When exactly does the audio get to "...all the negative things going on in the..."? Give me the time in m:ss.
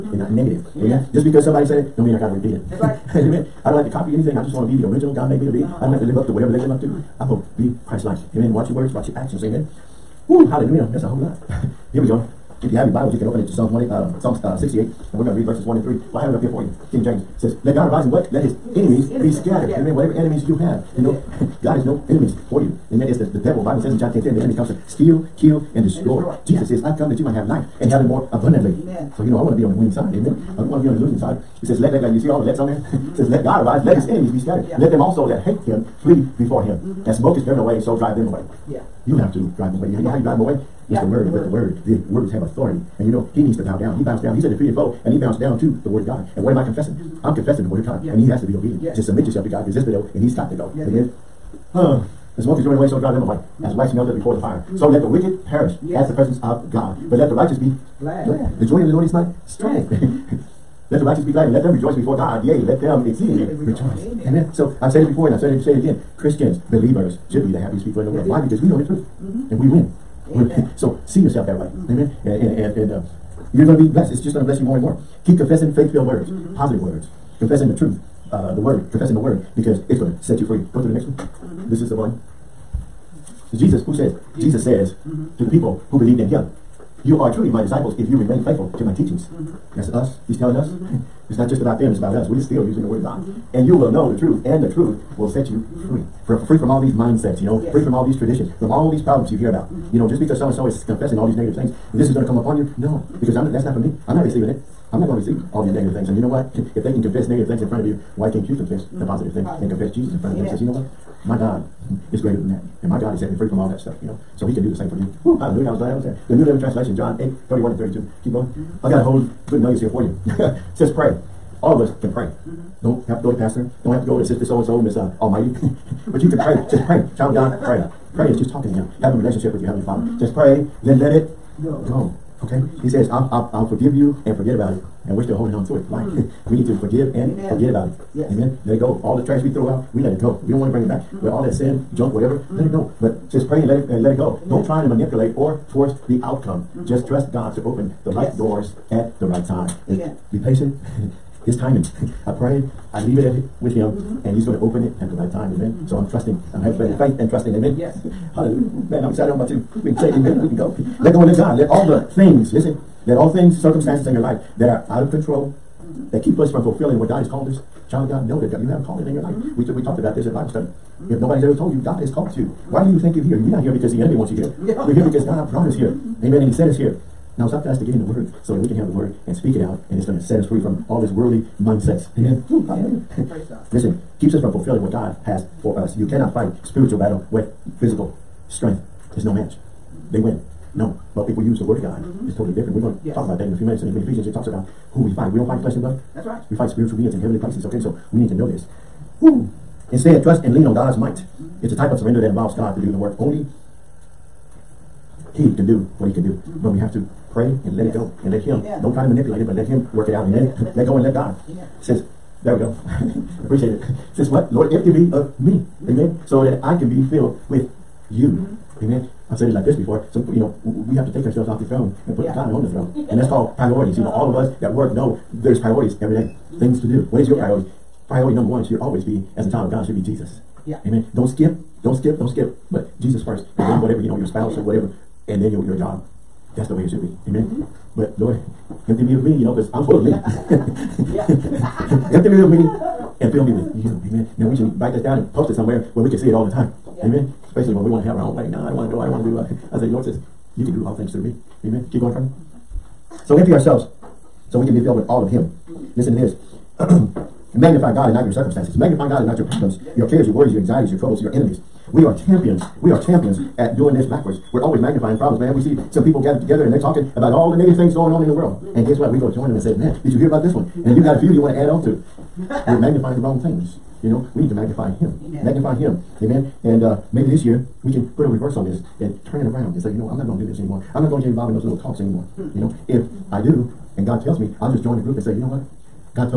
4:27.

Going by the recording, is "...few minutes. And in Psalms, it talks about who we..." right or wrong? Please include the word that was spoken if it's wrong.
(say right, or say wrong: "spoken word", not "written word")
wrong: "Ephesians", not "Psalms".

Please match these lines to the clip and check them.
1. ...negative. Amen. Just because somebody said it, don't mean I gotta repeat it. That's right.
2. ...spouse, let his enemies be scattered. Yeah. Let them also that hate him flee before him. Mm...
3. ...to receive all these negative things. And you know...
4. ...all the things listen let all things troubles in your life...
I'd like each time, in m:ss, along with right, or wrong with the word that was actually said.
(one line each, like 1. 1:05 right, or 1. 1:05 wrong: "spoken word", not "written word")
1. 0:00 right
2. 0:33 wrong: "arise", not "spouse"
3. 1:45 right
4. 2:41 wrong: "circumstances", not "troubles".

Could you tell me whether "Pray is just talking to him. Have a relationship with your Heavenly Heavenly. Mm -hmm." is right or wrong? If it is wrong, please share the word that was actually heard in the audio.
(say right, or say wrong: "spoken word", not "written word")
wrong: "Father", not "Heavenly".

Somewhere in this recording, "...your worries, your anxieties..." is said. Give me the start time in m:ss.
4:20.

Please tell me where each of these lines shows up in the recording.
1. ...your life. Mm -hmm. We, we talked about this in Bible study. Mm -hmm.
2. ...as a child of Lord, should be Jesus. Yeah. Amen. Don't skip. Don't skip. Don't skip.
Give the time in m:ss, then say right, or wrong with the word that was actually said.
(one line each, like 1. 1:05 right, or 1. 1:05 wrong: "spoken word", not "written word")
1. 2:49 right
2. 3:49 wrong: "God", not "Lord".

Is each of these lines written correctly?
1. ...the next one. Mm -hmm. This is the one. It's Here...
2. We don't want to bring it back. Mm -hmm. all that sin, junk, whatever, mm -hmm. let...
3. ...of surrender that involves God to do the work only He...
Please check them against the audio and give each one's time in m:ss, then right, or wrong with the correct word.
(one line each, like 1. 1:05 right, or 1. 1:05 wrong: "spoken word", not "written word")
1. 1:20 wrong: "Jesus", not "Here"
2. 2:20 right
3. 3:21 right.